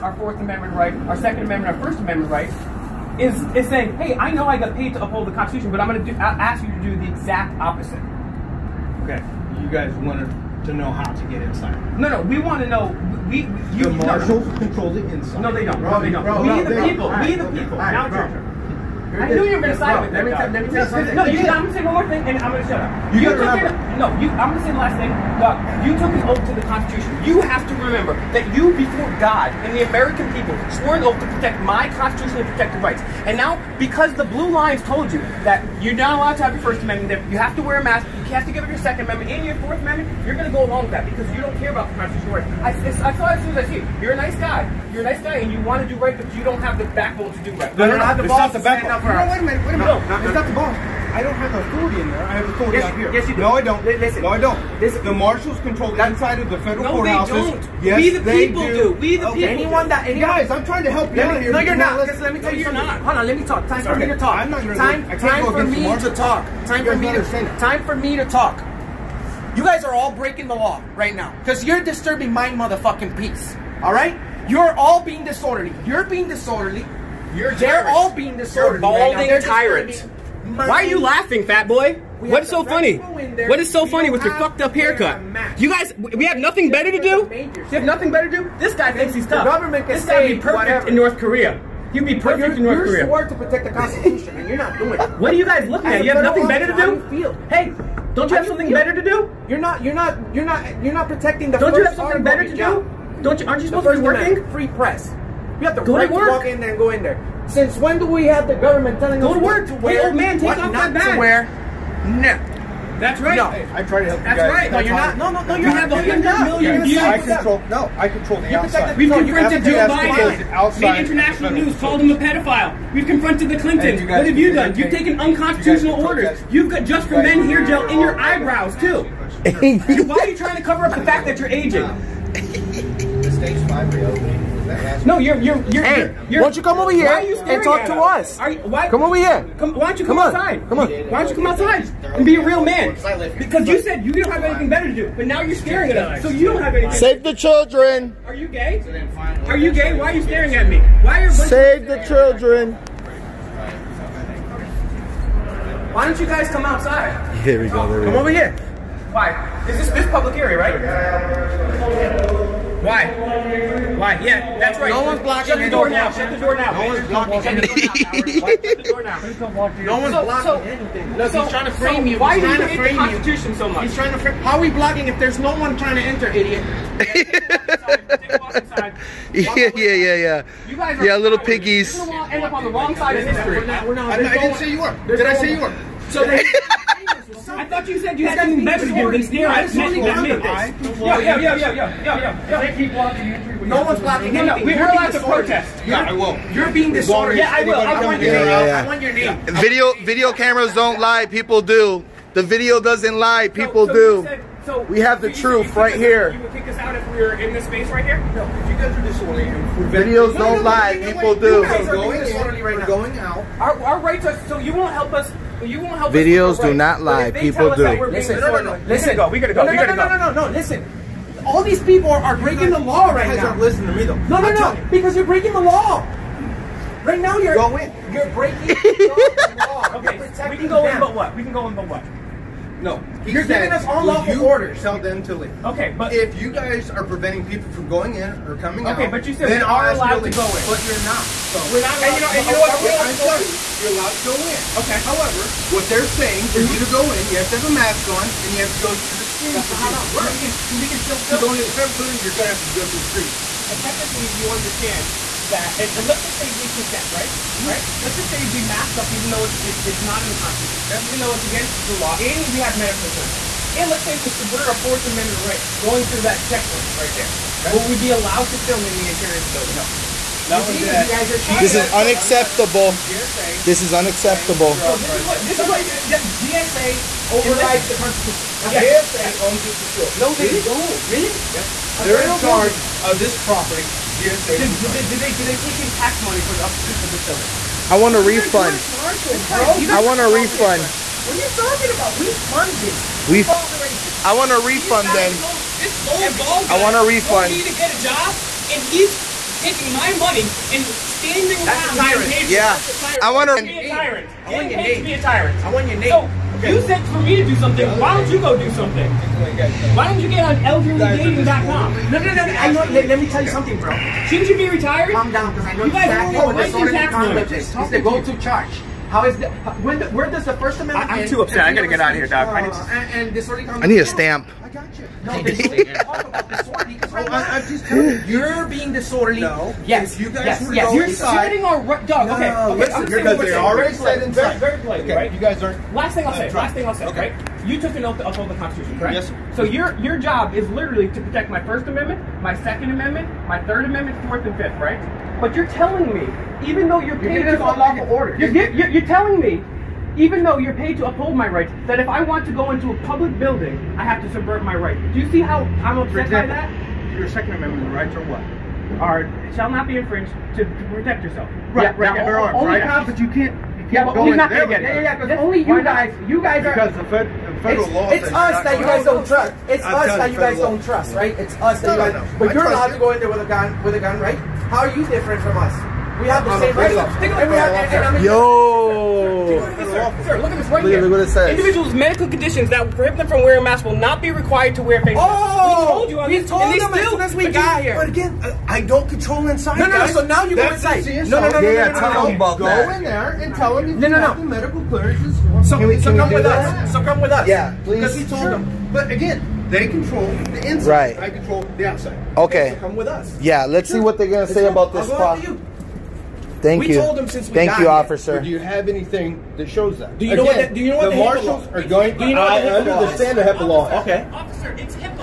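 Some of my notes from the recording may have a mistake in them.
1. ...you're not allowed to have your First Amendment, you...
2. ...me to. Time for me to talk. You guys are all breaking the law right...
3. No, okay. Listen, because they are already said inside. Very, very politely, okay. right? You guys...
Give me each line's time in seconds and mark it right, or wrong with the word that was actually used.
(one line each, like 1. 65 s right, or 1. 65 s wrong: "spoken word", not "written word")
1. 35 s right
2. 66 s right
3. 332 s right.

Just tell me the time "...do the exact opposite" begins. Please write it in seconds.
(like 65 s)
6 s.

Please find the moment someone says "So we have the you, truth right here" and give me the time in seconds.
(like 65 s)
204 s.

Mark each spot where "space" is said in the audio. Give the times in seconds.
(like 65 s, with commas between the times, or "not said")
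207 s.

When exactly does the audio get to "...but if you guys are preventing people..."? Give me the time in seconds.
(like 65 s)
235 s.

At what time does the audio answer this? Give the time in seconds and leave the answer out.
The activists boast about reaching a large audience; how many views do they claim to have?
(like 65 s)
115 s.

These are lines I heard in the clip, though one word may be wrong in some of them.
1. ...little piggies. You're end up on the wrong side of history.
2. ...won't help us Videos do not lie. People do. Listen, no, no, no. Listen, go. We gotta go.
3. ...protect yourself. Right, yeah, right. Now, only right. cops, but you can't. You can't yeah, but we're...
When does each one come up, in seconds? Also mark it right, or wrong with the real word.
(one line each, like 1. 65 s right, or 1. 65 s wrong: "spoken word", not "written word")
1. 181 s right
2. 214 s right
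3. 360 s right.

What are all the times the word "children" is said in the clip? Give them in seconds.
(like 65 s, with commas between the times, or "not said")
147 s, 152 s.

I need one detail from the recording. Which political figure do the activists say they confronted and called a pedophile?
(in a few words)
Joe Biden.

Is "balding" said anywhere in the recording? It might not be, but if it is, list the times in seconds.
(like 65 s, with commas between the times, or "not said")
78 s.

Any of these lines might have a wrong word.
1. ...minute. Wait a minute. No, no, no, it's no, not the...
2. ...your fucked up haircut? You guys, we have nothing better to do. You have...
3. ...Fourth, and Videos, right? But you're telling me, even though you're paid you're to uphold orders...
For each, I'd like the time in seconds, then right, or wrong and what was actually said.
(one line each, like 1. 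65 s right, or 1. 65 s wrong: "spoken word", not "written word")
1. 49 s right
2. 84 s right
3. 344 s wrong: "Fifth", not "Videos".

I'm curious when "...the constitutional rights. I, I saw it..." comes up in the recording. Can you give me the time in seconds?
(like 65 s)
41 s.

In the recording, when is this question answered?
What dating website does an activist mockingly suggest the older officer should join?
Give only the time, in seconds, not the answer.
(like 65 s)
310 s.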